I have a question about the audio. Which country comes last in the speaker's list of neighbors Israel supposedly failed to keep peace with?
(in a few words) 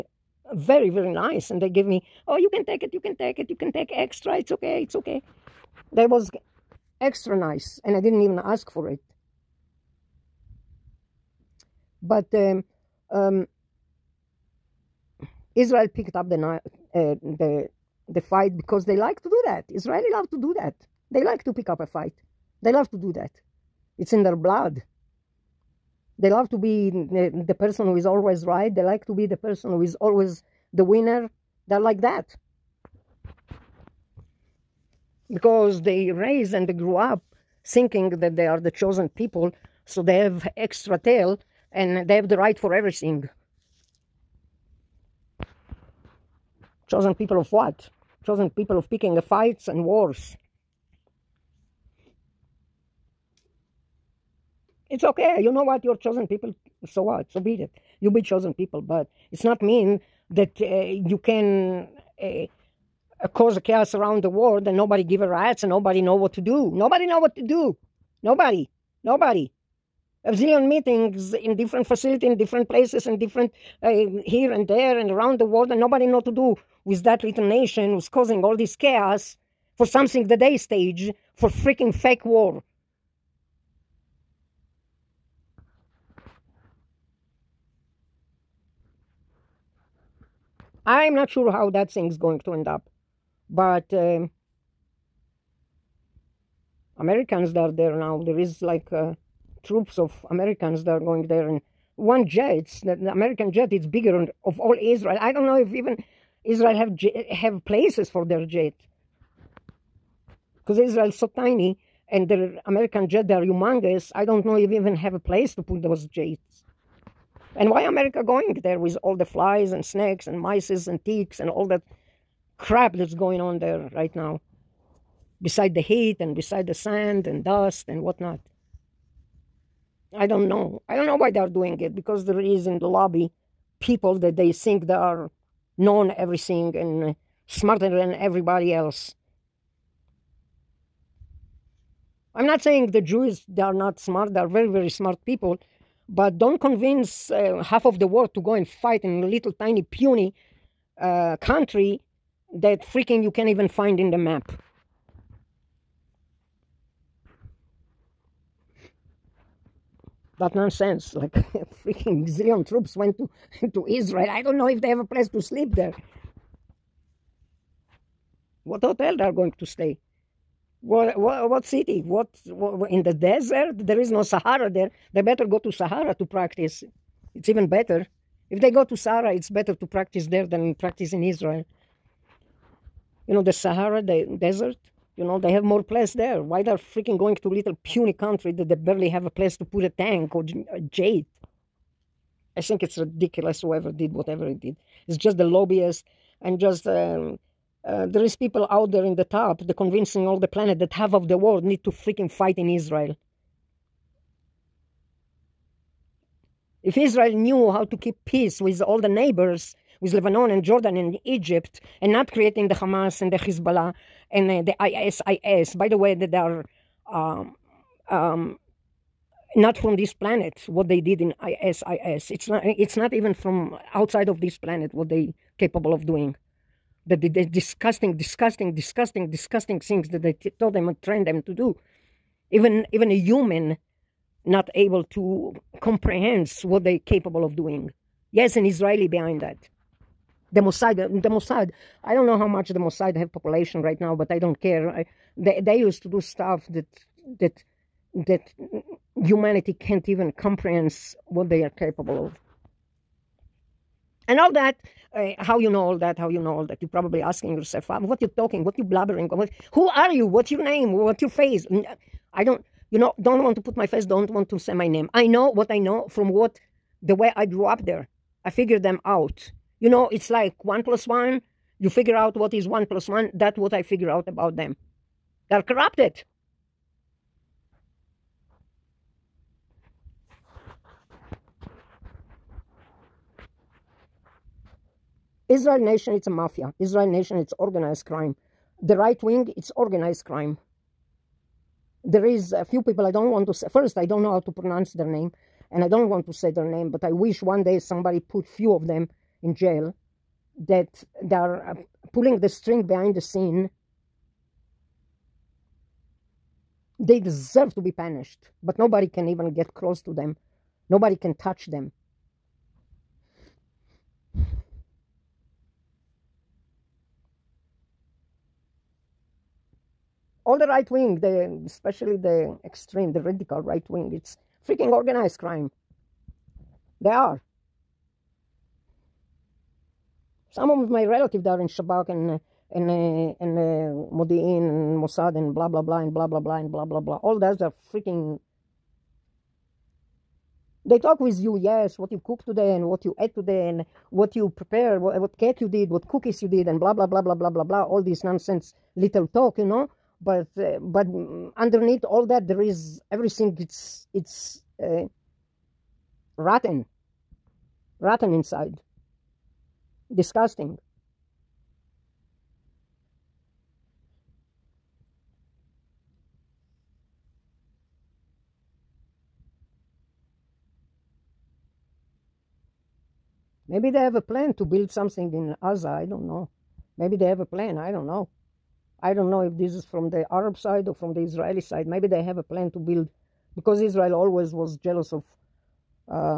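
Egypt.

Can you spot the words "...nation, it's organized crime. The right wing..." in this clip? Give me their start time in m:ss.
4:47.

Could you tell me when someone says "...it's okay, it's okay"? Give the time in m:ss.
0:04.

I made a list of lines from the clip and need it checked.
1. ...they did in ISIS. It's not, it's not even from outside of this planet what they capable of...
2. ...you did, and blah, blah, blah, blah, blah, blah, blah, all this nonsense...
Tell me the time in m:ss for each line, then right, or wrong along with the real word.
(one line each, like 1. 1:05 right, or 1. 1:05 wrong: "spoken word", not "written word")
1. 3:40 right
2. 5:46 right.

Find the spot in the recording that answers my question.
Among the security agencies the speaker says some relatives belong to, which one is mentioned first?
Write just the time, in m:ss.
5:31.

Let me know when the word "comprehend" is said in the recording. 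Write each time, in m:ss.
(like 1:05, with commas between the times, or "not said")
3:55, 4:10.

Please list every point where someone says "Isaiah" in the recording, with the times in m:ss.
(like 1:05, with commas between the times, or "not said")
not said.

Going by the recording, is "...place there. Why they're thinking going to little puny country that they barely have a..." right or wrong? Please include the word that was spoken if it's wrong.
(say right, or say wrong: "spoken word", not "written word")
wrong: "freaking", not "thinking".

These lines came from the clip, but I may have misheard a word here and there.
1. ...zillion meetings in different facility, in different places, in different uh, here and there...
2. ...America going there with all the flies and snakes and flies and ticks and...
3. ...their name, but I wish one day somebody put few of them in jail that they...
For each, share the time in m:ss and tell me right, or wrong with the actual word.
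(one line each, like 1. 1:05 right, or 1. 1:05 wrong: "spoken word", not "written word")
1. 1:10 right
2. 1:57 wrong: "mices", not "flies"
3. 4:56 right.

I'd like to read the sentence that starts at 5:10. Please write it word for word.
Nobody can touch them all the right wing, the especially the extreme, the radical right wing, it's freaking organized crime.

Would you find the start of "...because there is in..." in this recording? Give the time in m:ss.
2:11.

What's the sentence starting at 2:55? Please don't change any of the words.
They better go to Sahara to practice.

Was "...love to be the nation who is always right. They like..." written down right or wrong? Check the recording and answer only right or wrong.
wrong.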